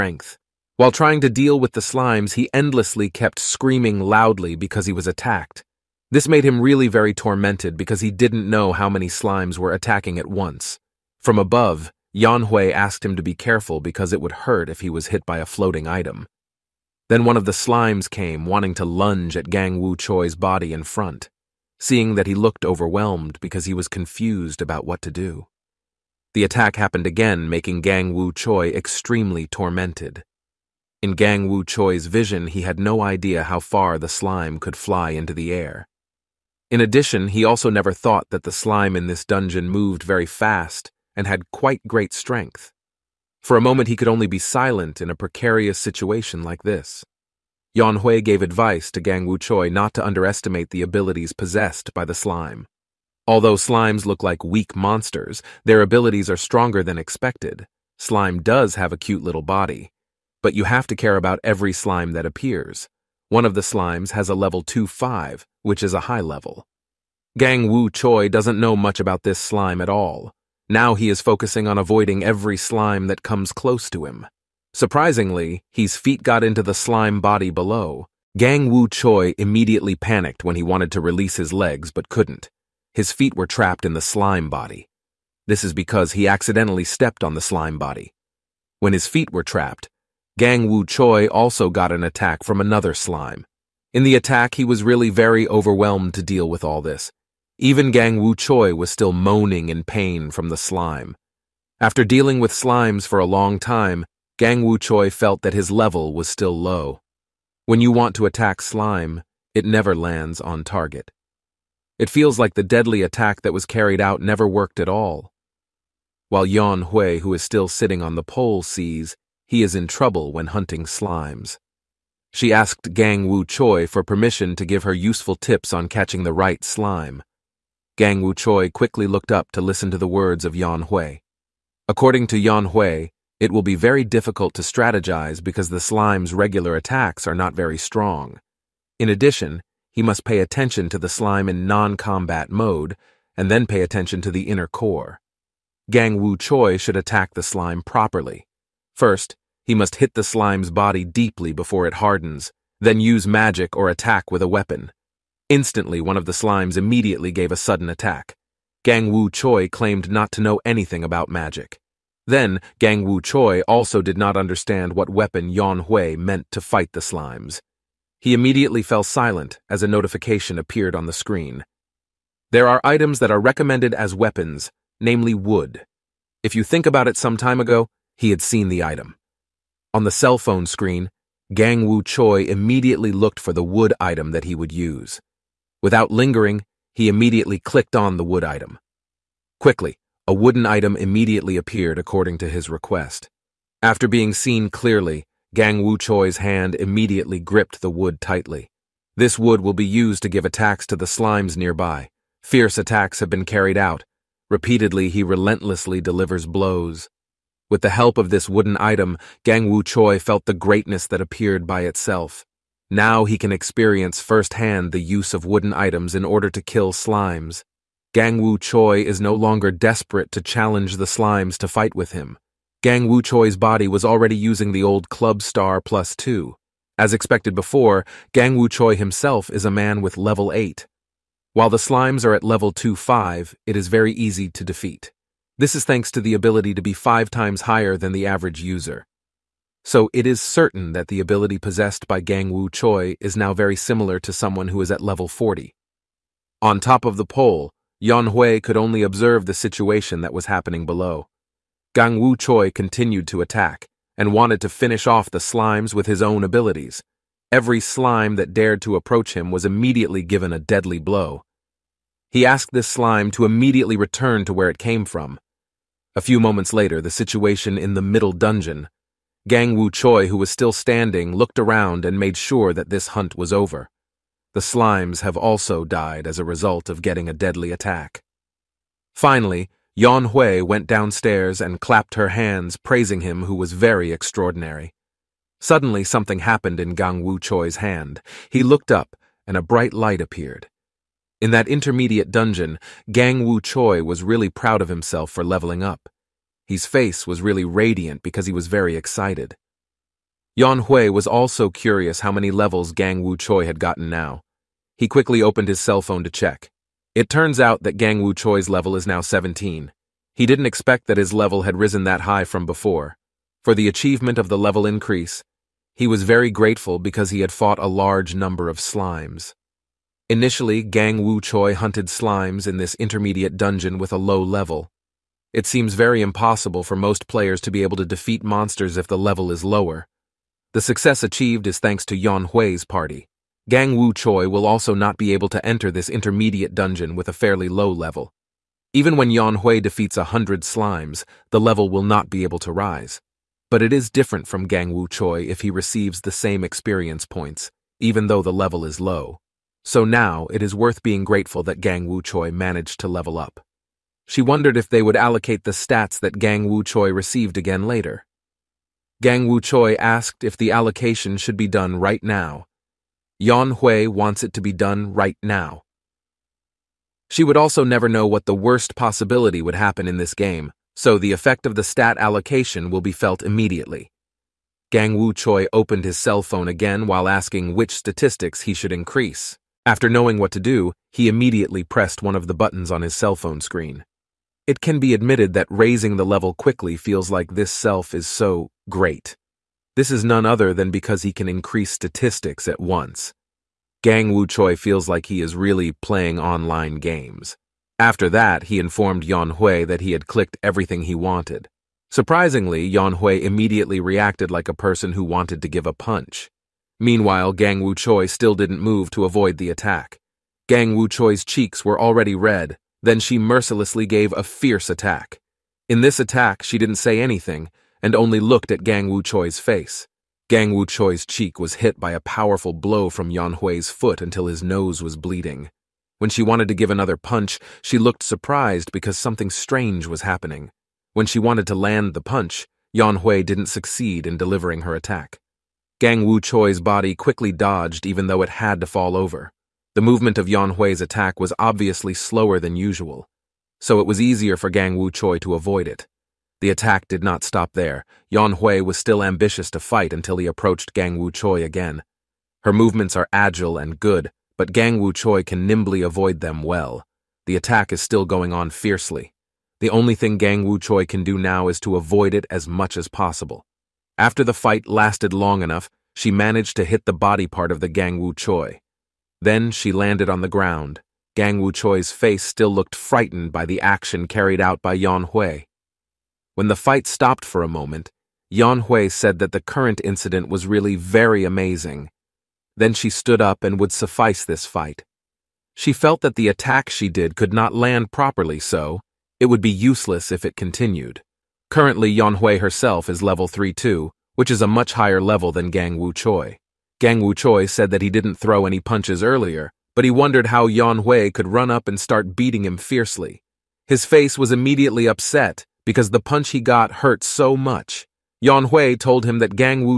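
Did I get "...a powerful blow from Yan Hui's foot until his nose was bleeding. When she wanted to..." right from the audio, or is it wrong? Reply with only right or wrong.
right.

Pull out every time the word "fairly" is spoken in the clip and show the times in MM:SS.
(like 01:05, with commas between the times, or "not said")
05:37.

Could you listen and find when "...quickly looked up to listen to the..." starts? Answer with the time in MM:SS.
02:08.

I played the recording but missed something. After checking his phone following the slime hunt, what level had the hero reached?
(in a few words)
17.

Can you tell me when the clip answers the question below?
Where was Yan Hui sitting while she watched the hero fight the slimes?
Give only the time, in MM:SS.
01:57.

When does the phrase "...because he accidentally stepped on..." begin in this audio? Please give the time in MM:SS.
01:25.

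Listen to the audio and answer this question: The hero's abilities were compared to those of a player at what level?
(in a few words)
40.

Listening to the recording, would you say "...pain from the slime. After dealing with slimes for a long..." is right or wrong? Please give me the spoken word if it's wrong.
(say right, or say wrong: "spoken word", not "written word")
right.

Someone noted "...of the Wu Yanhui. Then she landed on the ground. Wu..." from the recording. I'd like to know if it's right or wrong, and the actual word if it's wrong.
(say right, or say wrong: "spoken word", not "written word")
wrong: "Choi", not "Yanhui".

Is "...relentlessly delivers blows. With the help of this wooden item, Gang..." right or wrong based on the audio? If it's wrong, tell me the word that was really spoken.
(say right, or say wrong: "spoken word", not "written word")
right.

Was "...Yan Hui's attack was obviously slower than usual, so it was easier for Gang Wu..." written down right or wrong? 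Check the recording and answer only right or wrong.
right.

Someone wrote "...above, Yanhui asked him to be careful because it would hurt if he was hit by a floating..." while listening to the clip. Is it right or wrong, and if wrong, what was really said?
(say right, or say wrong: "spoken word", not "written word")
right.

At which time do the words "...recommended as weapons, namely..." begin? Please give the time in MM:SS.
02:53.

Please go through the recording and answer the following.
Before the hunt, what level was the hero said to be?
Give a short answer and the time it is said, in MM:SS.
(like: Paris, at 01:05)
8, at 03:50.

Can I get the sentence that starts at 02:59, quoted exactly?
On the cell phone screen, Gang Wu Choi immediately looked for the wood item that he would use.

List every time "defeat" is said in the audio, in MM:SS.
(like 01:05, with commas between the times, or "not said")
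03:54, 05:28, 05:39.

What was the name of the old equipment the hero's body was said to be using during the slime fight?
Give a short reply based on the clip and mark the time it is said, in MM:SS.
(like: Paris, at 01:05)
Club Star plus two, at 03:45.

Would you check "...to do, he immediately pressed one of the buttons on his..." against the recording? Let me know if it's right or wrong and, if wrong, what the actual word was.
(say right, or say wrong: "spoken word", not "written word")
right.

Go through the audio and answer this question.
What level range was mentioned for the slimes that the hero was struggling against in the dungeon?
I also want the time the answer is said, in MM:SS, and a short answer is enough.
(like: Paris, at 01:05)
2-5, at 01:04.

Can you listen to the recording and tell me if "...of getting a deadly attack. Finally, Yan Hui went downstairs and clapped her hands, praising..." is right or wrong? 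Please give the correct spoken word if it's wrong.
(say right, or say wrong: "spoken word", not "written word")
right.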